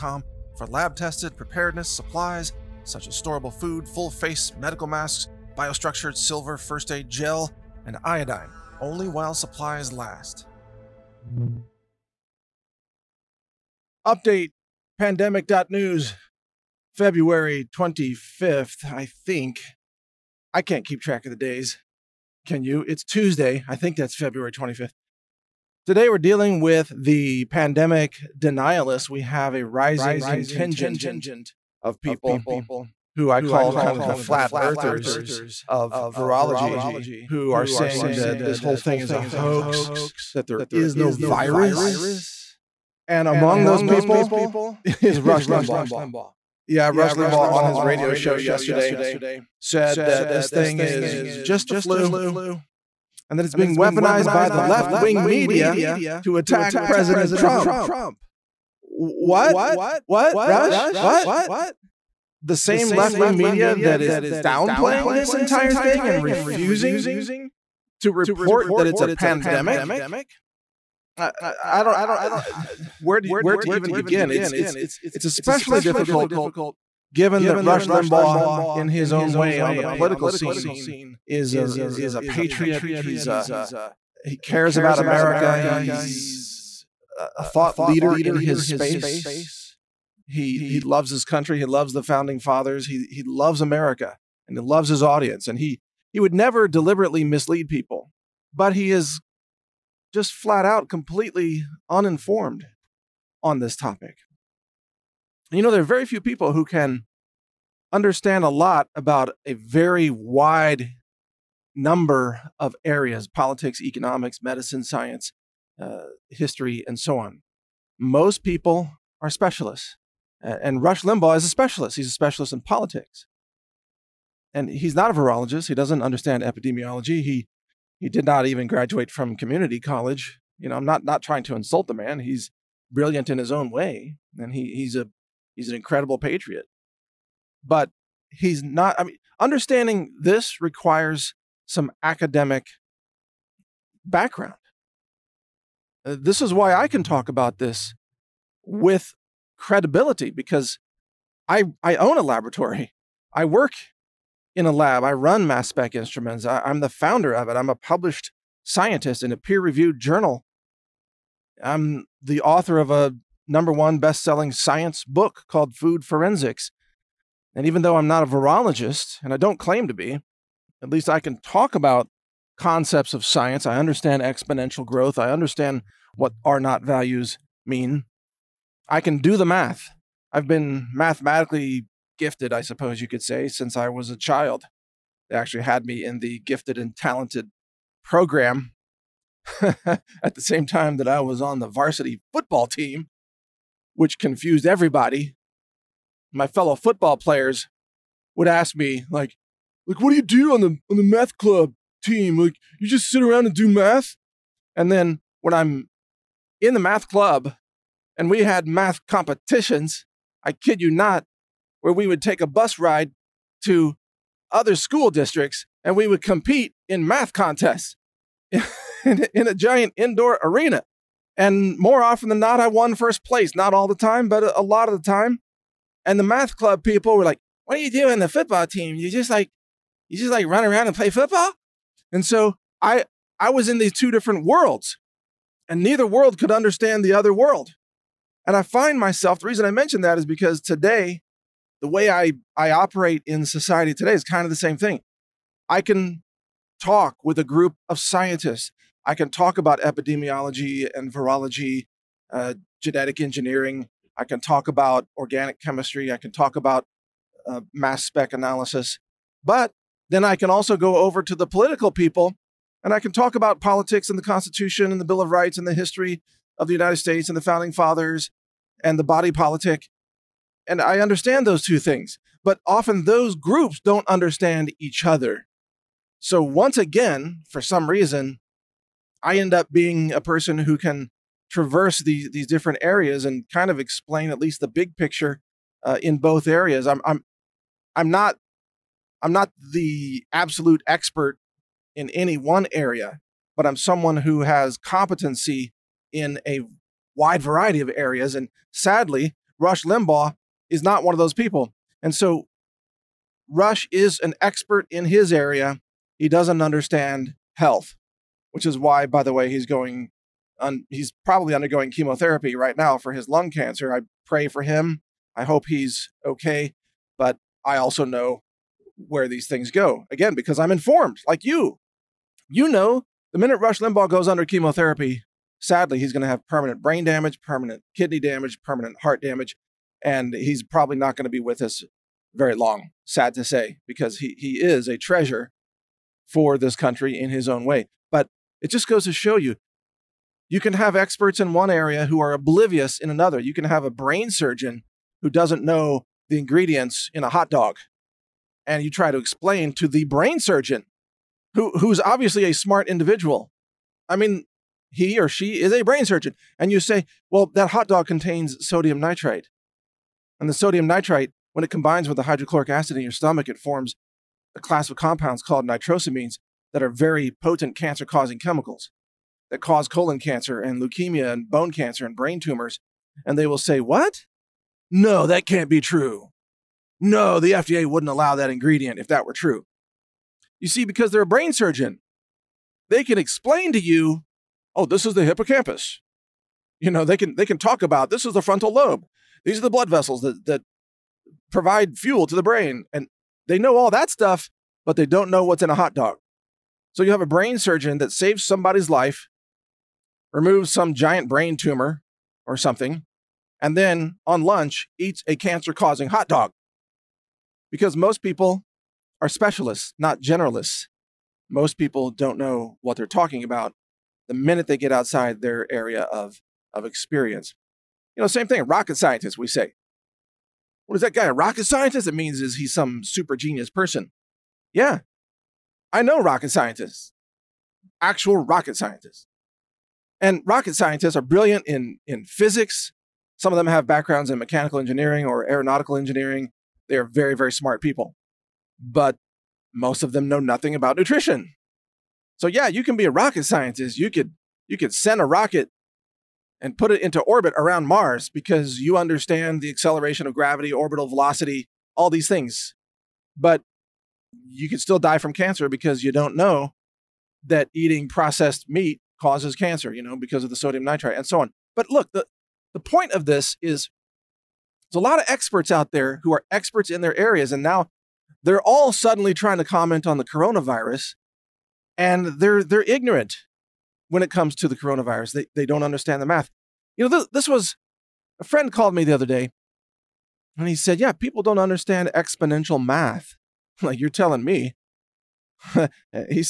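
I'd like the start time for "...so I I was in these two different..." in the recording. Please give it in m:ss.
3:52.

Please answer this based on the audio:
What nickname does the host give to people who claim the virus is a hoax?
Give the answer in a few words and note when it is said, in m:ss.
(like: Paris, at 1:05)
flat earthers of virology, at 0:34.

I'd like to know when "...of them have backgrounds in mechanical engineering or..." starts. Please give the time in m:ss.
7:13.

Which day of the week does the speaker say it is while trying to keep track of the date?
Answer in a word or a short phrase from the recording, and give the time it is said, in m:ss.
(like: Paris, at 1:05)
Tuesday, at 0:23.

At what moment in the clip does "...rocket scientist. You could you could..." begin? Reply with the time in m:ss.
7:23.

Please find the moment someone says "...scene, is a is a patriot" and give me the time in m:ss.
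1:20.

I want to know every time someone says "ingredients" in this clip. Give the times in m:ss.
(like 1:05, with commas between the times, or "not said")
5:46, 6:18.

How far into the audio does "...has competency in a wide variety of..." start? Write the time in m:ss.
4:54.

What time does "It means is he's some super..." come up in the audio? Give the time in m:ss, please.
7:02.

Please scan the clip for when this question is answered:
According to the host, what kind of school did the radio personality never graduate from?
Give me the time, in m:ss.
2:09.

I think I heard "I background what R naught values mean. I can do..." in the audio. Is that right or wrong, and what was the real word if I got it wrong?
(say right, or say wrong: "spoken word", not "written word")
wrong: "understand", not "background".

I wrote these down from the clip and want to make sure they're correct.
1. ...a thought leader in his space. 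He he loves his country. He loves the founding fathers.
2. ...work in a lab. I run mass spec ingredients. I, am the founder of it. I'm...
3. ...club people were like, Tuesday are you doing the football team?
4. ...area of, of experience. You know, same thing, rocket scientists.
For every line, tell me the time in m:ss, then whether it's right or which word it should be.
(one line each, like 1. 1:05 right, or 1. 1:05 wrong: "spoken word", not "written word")
1. 1:27 right
2. 2:33 wrong: "instruments", not "ingredients"
3. 3:46 wrong: "What", not "Tuesday"
4. 6:55 right.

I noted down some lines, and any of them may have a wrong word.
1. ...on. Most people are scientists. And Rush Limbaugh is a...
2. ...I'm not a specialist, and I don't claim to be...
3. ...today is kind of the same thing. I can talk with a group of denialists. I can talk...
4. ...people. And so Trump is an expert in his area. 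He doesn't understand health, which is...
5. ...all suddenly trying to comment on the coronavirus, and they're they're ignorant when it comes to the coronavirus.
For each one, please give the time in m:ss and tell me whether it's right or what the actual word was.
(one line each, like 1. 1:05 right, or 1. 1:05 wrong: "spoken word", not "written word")
1. 1:57 wrong: "specialists", not "scientists"
2. 2:47 wrong: "virologist", not "specialist"
3. 4:03 wrong: "scientists", not "denialists"
4. 5:01 wrong: "Rush", not "Trump"
5. 7:48 right.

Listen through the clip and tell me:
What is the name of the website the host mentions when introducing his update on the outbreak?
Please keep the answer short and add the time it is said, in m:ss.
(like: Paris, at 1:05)
pandemic.news, at 0:14.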